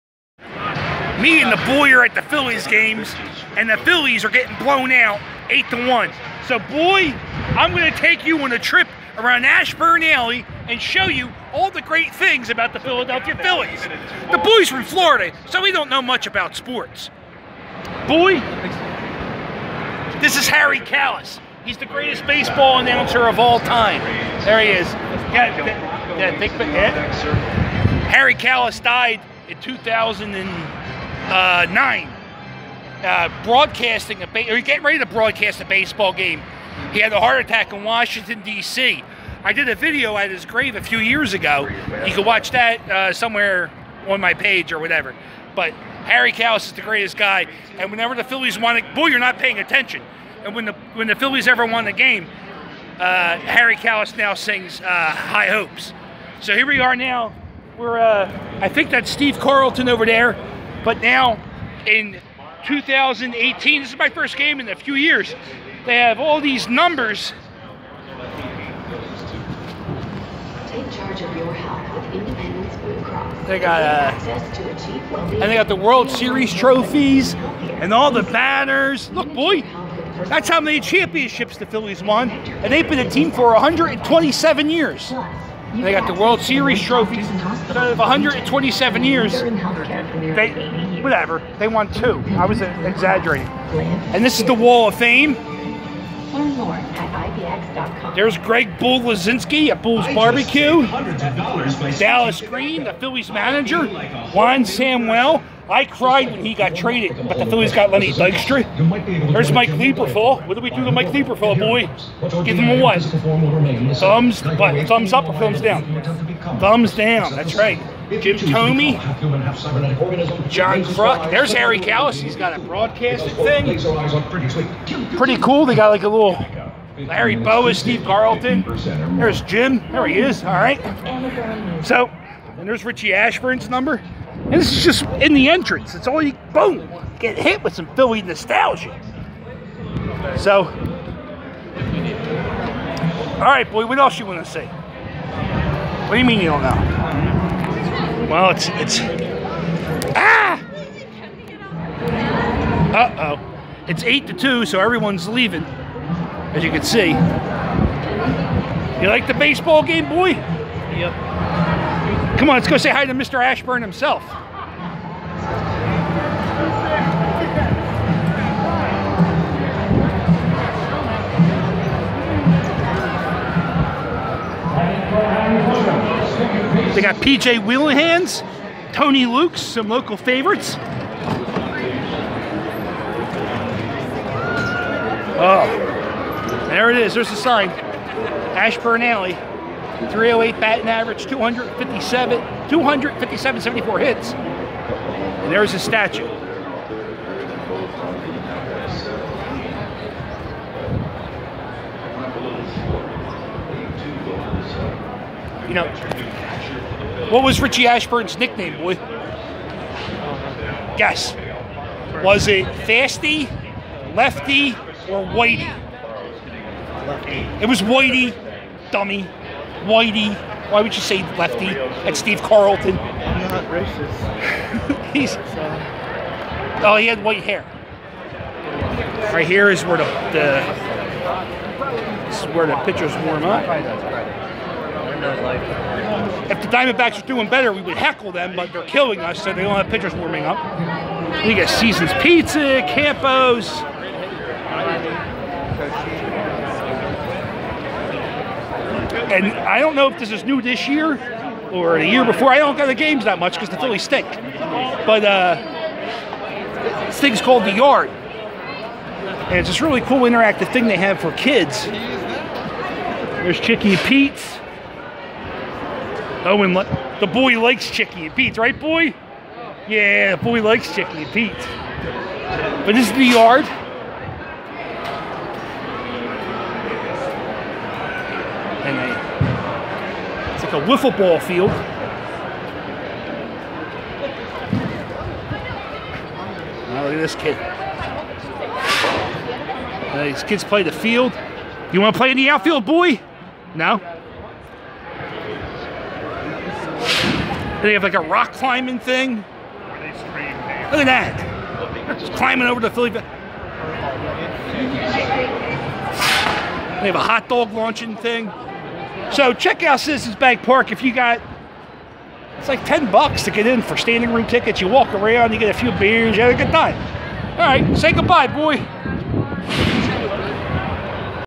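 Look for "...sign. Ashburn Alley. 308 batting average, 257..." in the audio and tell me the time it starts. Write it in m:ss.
3:07.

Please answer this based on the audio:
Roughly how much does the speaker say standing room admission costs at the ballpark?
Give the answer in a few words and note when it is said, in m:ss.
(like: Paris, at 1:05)
$10, at 5:12.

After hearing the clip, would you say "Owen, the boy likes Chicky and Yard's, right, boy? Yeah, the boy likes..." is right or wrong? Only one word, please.
wrong.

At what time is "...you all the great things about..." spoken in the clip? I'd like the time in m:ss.
0:11.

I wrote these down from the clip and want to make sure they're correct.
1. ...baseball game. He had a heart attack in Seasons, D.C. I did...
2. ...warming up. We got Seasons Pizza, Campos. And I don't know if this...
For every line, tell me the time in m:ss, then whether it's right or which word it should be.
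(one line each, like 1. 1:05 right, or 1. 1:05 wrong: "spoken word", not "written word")
1. 0:35 wrong: "Washington", not "Seasons"
2. 4:00 right.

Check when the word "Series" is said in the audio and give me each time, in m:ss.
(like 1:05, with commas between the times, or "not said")
1:16, 1:26.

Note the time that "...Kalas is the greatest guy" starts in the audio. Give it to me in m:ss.
0:46.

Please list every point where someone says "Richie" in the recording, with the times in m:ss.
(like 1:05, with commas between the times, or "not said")
2:12, 3:27.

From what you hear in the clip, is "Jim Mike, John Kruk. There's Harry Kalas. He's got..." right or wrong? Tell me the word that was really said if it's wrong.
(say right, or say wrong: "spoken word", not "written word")
wrong: "Thome", not "Mike".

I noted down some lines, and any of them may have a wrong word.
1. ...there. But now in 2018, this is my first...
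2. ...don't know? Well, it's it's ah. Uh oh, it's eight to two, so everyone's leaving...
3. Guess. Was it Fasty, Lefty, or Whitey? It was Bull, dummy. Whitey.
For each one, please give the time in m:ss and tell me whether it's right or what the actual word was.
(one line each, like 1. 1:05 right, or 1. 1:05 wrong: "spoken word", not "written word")
1. 1:00 right
2. 2:26 right
3. 3:30 wrong: "Whitey", not "Bull".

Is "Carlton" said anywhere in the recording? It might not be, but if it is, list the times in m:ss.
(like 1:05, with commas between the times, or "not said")
0:59, 2:08, 3:42.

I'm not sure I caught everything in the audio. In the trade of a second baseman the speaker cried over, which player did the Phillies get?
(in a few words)
Lenny Dykstra.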